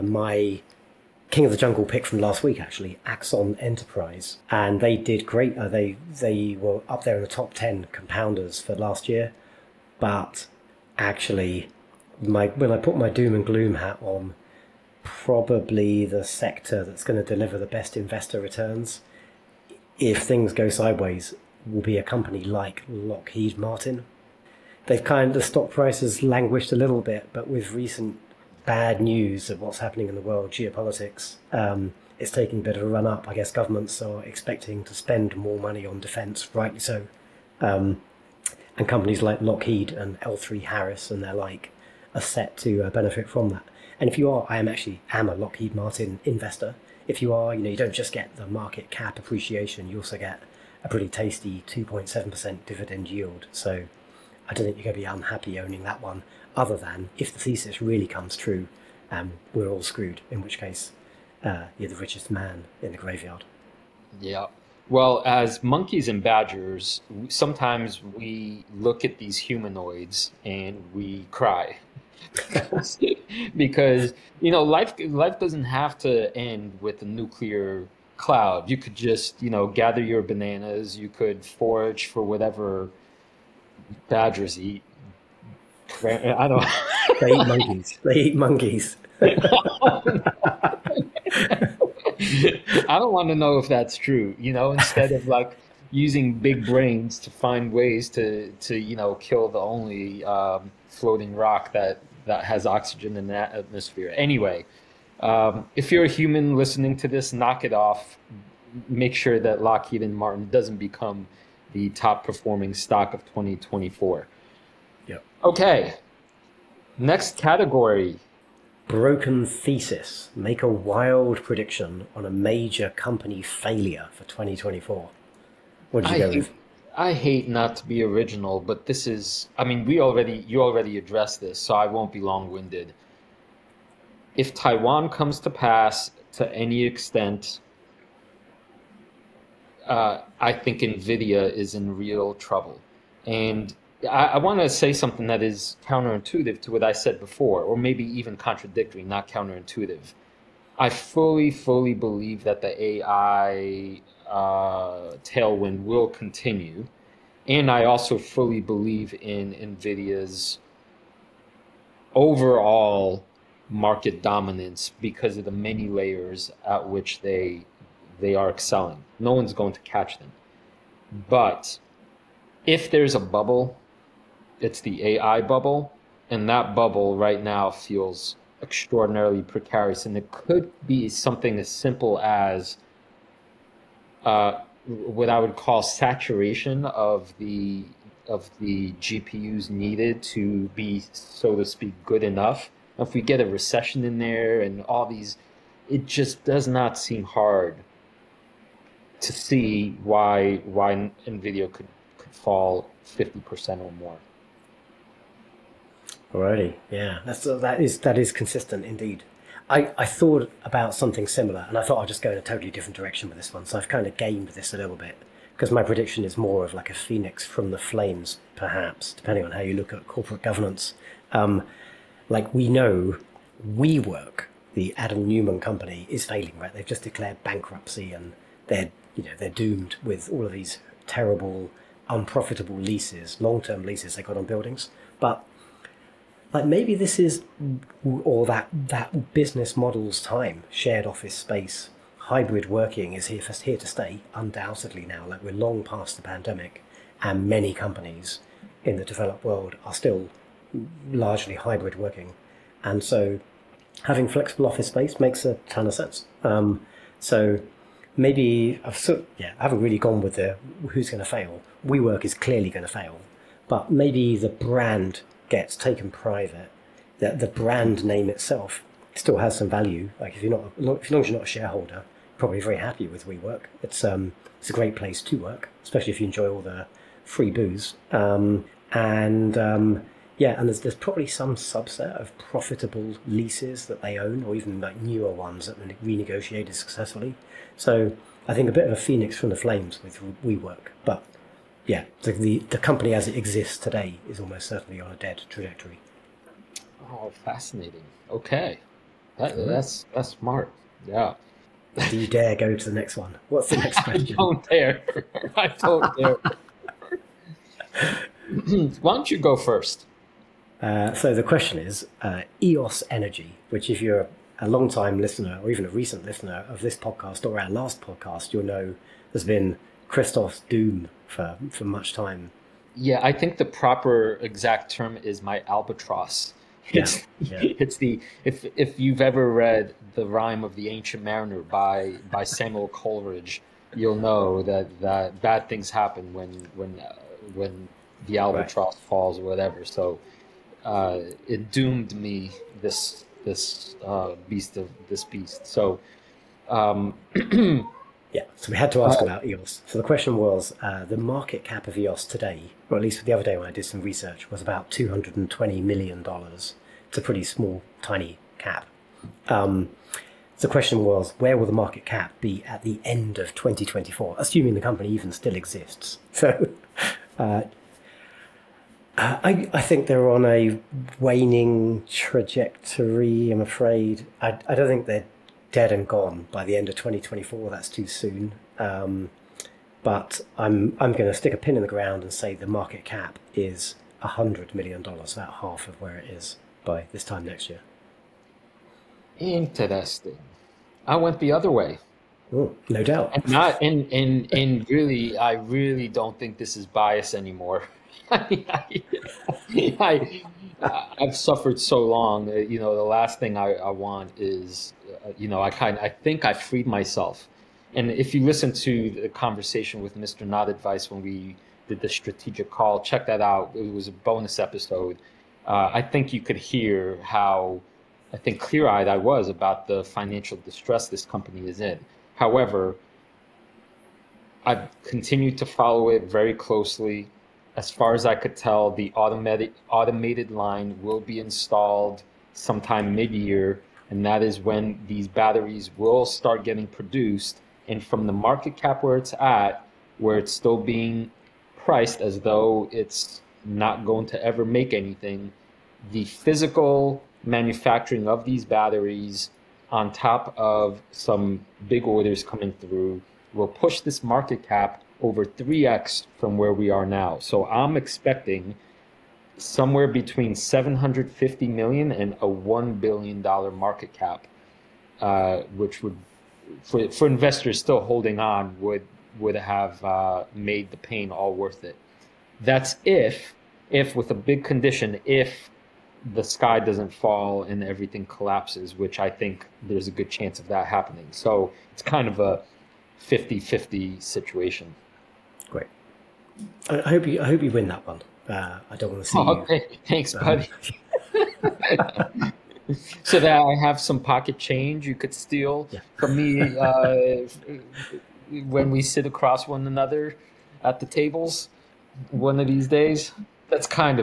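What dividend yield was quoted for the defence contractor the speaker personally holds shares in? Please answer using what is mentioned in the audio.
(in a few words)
2.7%.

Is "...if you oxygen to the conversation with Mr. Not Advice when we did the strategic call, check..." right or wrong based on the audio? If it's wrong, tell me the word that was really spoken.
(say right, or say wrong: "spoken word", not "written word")
wrong: "listen", not "oxygen".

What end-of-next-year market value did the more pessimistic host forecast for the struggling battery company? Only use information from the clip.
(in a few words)
$100 million.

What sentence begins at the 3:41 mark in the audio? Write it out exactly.
Um, like we know WeWork, the Adam Neumann company, is failing, right?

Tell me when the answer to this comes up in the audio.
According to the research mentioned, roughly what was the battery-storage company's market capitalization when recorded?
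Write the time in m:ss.
5:54.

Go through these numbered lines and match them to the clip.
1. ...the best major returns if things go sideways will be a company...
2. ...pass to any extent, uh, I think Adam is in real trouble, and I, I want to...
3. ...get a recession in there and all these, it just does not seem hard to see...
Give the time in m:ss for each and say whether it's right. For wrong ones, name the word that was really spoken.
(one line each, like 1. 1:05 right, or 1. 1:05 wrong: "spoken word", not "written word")
1. 0:17 wrong: "investor", not "major"
2. 2:15 wrong: "Nvidia", not "Adam"
3. 3:13 right.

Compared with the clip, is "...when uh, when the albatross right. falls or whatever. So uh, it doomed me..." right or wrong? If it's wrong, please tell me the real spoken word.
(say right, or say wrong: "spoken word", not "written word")
right.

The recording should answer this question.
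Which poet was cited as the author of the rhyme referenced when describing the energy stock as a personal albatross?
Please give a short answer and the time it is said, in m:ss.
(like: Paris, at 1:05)
Samuel Coleridge, at 5:32.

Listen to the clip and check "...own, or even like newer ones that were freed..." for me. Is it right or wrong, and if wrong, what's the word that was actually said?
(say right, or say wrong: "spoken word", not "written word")
wrong: "renegotiated", not "freed".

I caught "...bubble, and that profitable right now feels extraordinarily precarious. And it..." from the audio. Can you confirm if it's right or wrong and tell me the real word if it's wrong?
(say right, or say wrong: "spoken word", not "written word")
wrong: "bubble", not "profitable".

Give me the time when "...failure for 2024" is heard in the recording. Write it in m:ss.
2:03.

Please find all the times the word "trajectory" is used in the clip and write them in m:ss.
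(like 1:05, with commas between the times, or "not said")
4:55, 6:12.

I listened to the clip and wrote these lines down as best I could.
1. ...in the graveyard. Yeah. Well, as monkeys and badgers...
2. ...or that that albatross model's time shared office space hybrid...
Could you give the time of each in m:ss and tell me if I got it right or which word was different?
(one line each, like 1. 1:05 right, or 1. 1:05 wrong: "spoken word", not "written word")
1. 1:02 right
2. 3:58 wrong: "business", not "albatross".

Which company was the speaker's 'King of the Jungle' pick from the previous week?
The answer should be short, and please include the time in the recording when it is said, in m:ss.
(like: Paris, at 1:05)
Axon Enterprise, at 0:03.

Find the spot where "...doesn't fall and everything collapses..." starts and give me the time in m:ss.
7:56.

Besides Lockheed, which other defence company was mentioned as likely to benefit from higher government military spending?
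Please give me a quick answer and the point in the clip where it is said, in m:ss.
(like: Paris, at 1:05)
L3 Harris, at 0:40.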